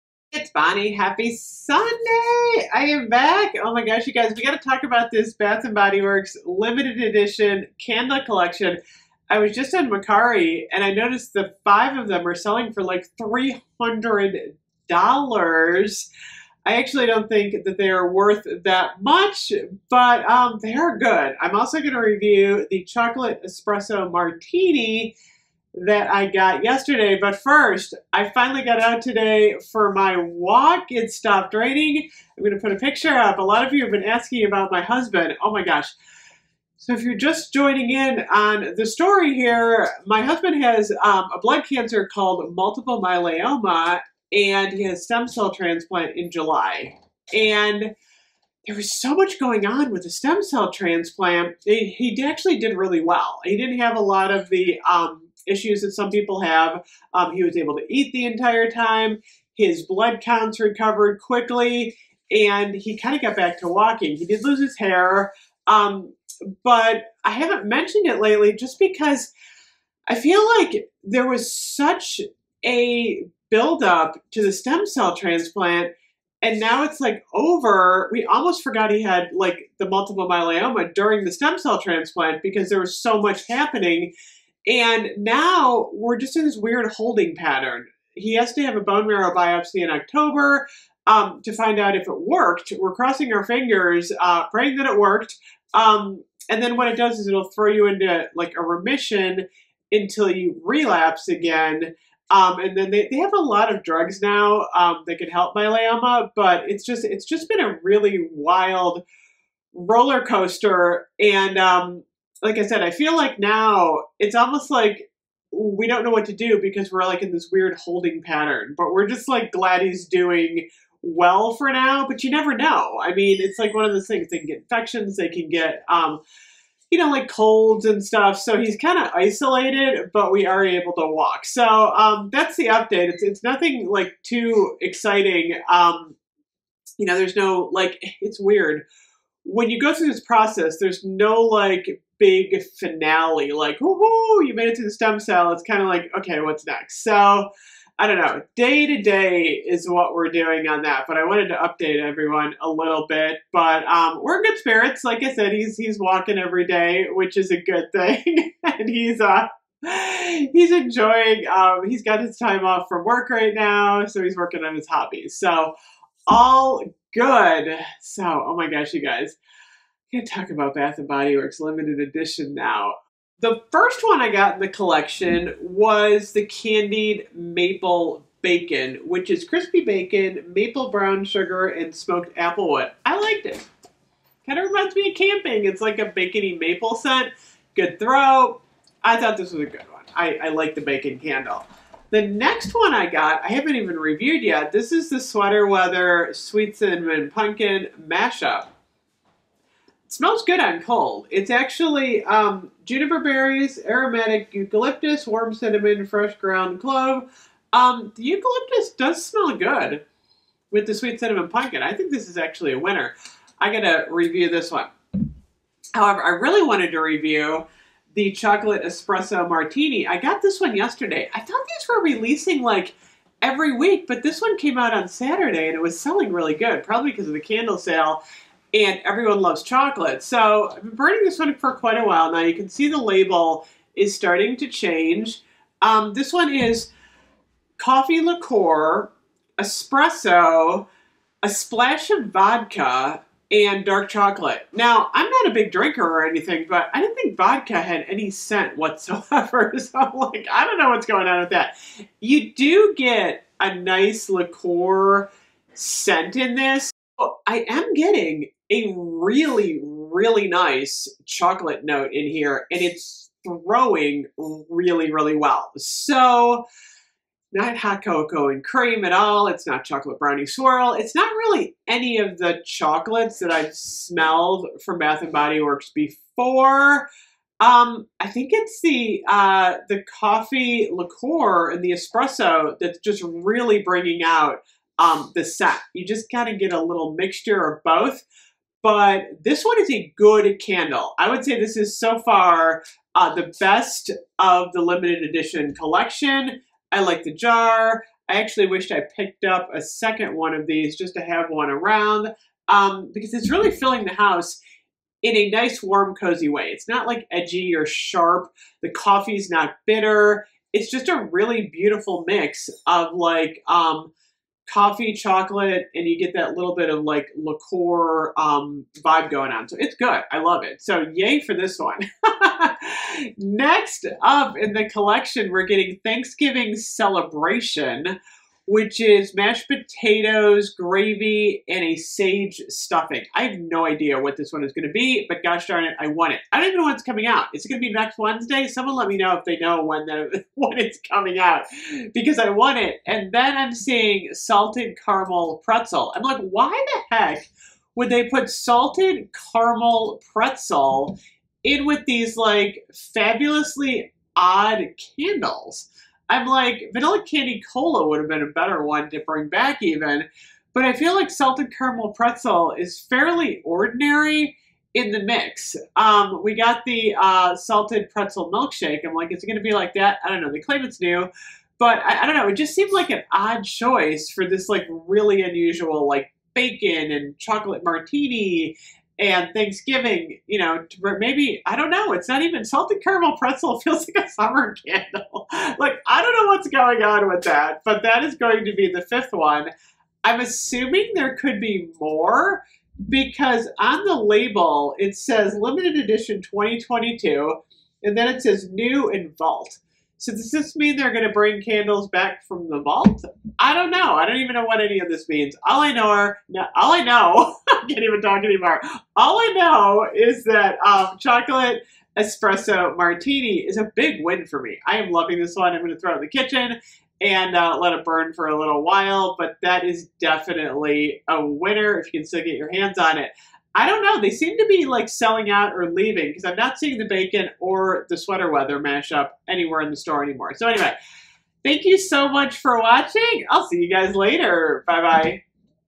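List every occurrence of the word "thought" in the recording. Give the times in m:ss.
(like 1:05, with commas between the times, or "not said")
3:09, 3:41.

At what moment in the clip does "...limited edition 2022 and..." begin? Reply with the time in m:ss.
6:35.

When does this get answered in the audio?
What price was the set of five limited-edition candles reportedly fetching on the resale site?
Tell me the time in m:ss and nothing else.
0:13.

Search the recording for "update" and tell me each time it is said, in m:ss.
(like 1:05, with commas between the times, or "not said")
2:12, 2:31.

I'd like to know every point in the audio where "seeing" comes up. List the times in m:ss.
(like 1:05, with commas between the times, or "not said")
5:43, 7:06.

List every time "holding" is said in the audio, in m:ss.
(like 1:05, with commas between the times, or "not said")
1:26, 1:57.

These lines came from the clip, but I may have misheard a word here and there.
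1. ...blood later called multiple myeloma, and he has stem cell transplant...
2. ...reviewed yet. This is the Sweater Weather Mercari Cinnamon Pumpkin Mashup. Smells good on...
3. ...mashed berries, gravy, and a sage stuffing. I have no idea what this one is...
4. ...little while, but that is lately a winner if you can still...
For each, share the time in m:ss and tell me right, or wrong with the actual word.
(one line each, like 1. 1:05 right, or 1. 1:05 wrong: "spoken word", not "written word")
1. 0:41 wrong: "cancer", not "later"
2. 3:13 wrong: "Sweet", not "Mercari"
3. 5:29 wrong: "potatoes", not "berries"
4. 6:58 wrong: "definitely", not "lately".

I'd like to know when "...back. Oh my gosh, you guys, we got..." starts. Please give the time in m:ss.
0:03.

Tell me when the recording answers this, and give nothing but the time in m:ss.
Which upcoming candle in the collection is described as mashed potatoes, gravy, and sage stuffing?
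5:26.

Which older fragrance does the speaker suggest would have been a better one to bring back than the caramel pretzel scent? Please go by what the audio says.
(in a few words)
Vanilla candy cola.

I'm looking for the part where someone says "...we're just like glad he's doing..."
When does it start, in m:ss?
1:58.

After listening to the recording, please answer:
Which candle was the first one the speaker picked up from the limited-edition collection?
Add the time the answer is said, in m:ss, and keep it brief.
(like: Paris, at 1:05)
Candied maple bacon, at 2:56.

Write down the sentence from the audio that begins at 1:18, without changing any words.
We almost forgot he had like the multiple myeloma during the stem cell transplant because there was so much happening.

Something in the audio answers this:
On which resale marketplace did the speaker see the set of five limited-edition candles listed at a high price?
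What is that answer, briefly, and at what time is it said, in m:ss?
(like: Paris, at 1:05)
Mercari, at 0:09.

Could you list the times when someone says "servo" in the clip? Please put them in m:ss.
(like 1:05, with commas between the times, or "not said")
not said.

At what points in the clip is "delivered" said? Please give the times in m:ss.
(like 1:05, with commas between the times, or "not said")
not said.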